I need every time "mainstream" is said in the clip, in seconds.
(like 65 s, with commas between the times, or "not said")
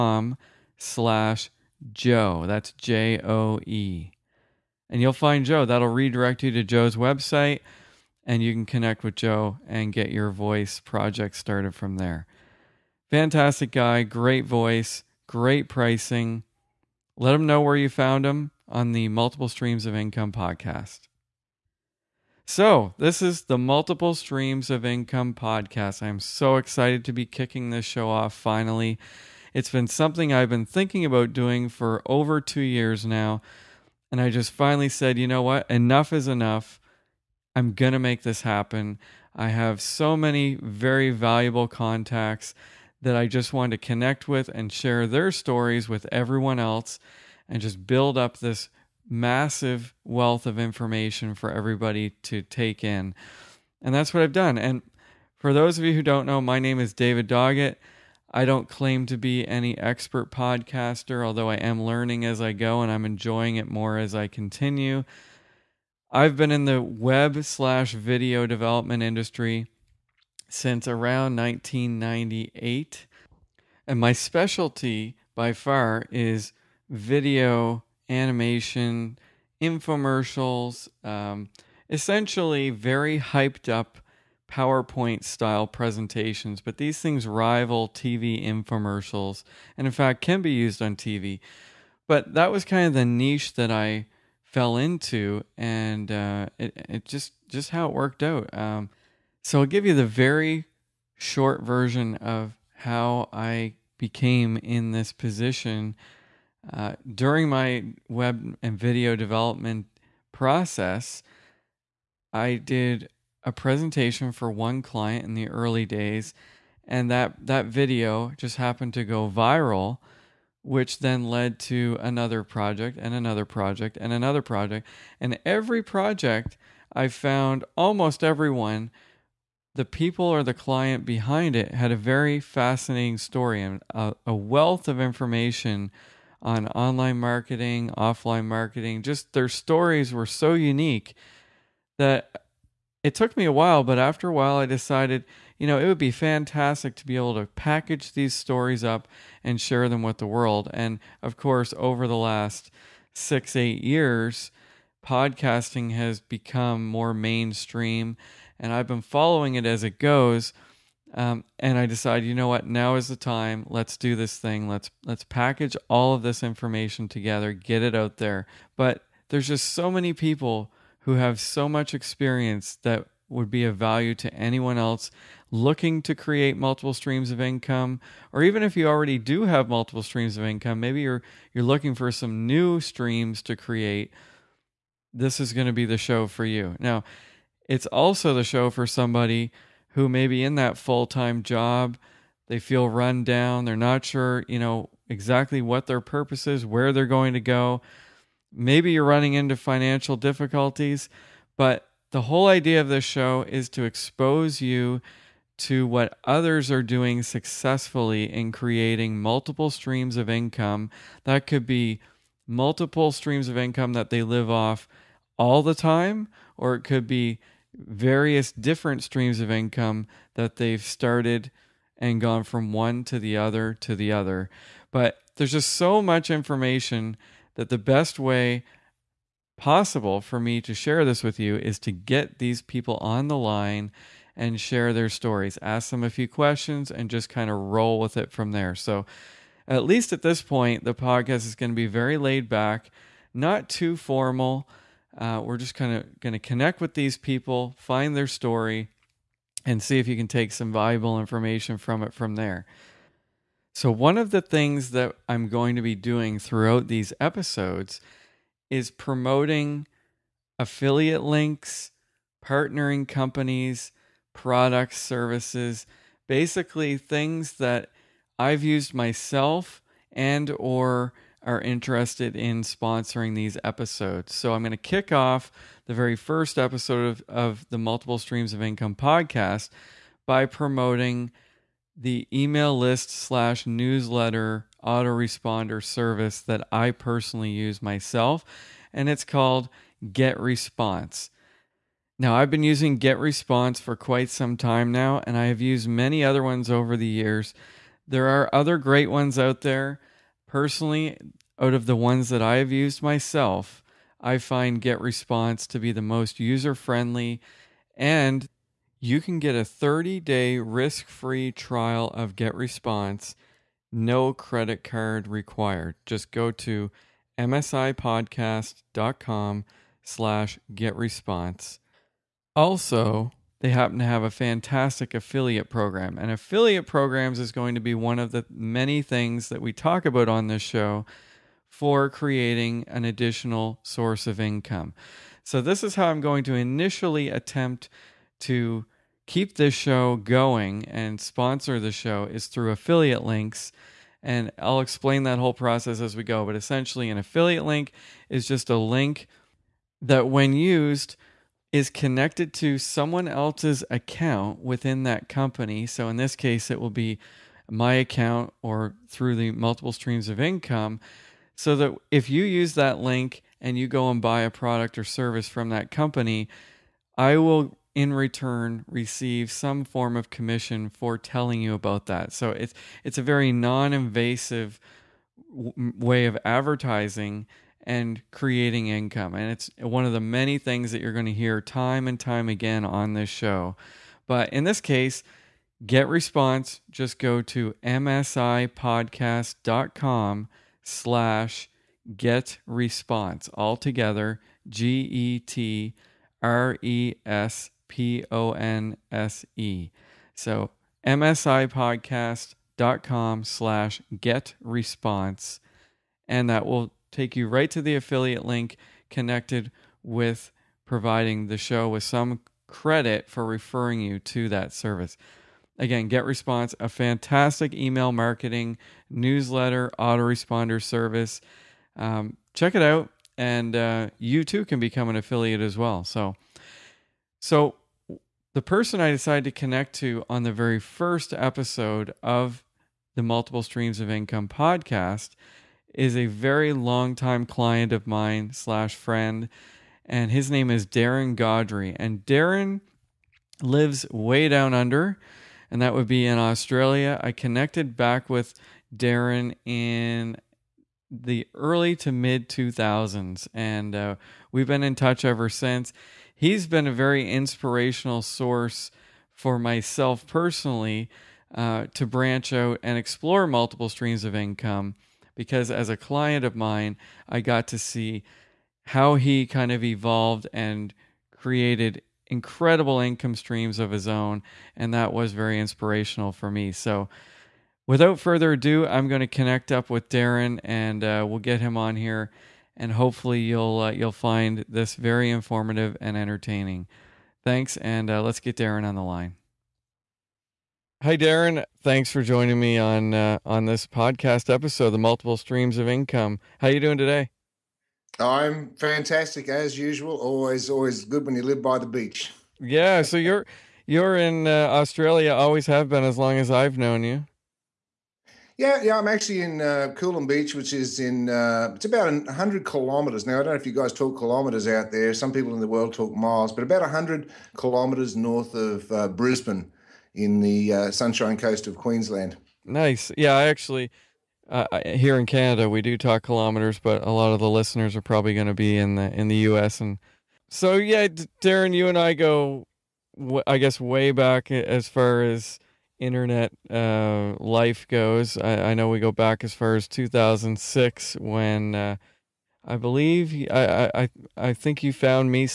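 157 s.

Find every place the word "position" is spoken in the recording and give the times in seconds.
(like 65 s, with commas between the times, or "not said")
105 s.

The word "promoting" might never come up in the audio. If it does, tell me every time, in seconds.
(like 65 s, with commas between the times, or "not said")
258 s, 280 s.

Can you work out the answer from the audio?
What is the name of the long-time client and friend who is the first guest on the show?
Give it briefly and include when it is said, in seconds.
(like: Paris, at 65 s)
Darren Gaudry, at 440 s.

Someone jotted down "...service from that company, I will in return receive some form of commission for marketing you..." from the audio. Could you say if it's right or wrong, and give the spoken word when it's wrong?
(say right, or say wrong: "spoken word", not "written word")
wrong: "telling", not "marketing".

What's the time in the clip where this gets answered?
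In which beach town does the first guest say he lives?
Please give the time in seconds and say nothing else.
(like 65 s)
509 s.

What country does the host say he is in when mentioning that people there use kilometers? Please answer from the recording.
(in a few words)
Canada.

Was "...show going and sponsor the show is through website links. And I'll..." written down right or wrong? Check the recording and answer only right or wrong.
wrong.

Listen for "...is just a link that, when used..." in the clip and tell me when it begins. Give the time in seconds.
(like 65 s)
348 s.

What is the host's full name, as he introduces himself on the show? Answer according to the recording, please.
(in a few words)
David Doggett.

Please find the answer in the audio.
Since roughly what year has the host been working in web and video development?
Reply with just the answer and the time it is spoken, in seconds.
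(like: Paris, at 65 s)
1998, at 71 s.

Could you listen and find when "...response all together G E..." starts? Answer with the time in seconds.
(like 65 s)
392 s.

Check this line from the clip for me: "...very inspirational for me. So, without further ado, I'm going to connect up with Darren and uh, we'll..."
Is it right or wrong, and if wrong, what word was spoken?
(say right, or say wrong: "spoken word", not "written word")
right.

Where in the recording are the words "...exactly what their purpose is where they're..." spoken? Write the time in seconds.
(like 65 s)
195 s.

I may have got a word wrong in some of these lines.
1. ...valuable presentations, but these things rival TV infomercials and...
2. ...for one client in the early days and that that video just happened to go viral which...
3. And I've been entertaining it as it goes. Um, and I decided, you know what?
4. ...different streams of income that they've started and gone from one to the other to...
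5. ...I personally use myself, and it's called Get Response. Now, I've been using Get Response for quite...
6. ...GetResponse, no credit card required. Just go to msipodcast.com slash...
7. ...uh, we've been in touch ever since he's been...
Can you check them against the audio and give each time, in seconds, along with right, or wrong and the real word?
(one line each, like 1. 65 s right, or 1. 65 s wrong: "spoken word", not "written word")
1. 85 s wrong: "style", not "valuable"
2. 114 s right
3. 158 s wrong: "following", not "entertaining"
4. 218 s right
5. 286 s right
6. 312 s right
7. 453 s right.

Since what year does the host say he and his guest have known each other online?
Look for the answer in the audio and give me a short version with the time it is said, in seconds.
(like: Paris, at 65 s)
2006, at 539 s.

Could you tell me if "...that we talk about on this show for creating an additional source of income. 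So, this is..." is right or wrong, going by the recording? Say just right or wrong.
right.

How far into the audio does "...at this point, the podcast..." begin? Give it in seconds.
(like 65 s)
240 s.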